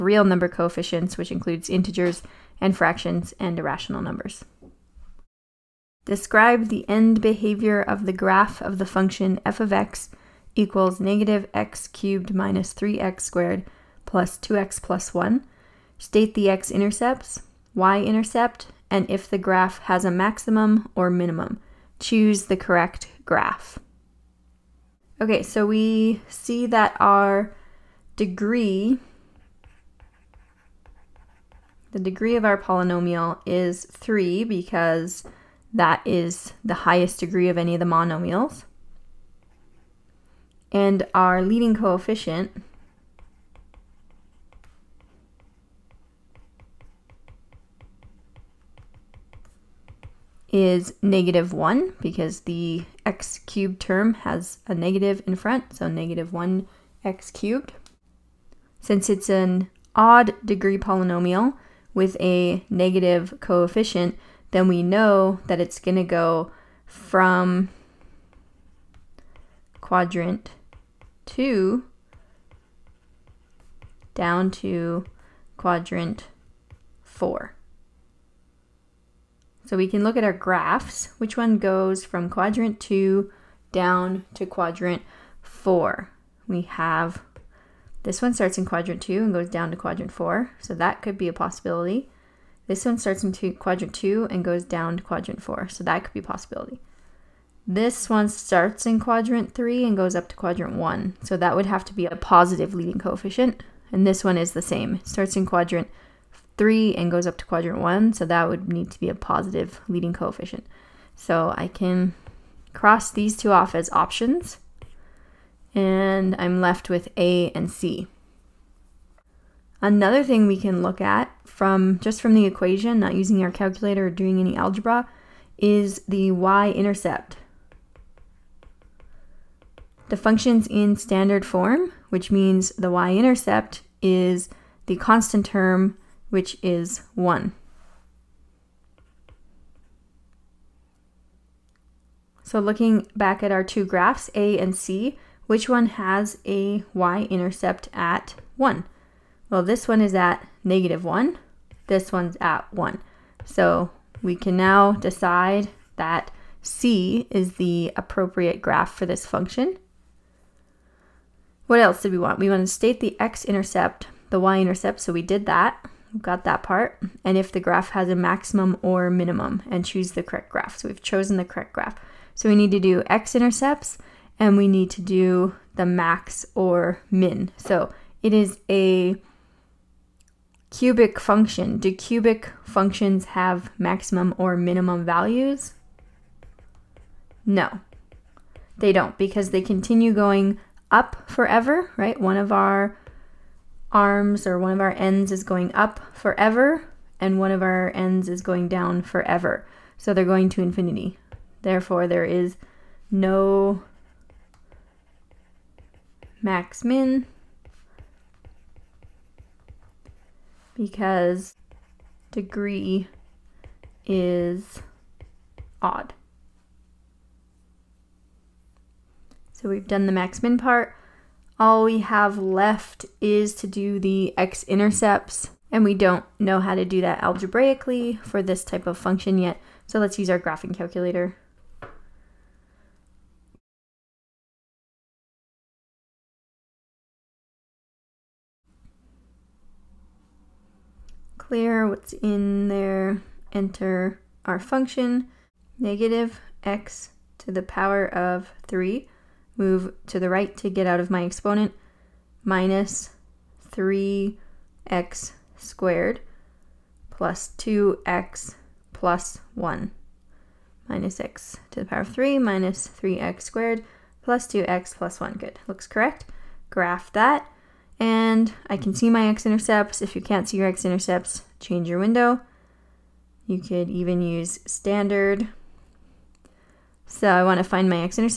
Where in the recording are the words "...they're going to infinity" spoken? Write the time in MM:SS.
03:20.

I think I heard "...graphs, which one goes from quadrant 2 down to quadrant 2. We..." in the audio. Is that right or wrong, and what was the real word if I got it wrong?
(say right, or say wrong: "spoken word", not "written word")
wrong: "4", not "2".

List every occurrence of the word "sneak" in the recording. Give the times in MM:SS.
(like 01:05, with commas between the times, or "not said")
not said.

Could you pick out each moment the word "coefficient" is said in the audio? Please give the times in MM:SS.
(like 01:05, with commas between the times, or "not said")
00:00, 00:41, 01:03, 01:43, 01:50.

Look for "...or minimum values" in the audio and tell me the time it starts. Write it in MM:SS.
03:04.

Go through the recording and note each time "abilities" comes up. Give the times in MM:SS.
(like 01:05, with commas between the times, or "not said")
not said.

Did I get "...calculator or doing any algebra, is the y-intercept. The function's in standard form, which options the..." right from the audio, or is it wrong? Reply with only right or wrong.
wrong.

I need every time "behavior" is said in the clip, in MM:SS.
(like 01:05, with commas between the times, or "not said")
00:07.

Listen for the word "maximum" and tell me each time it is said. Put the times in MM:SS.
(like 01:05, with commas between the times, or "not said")
00:20, 02:48, 03:03.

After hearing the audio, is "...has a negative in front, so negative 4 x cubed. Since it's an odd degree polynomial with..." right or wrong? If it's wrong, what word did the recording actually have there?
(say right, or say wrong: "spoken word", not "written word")
wrong: "1", not "4".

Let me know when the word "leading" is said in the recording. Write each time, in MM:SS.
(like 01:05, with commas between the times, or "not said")
00:41, 01:42, 01:49.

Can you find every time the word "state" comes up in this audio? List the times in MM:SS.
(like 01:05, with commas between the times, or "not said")
00:15, 02:42.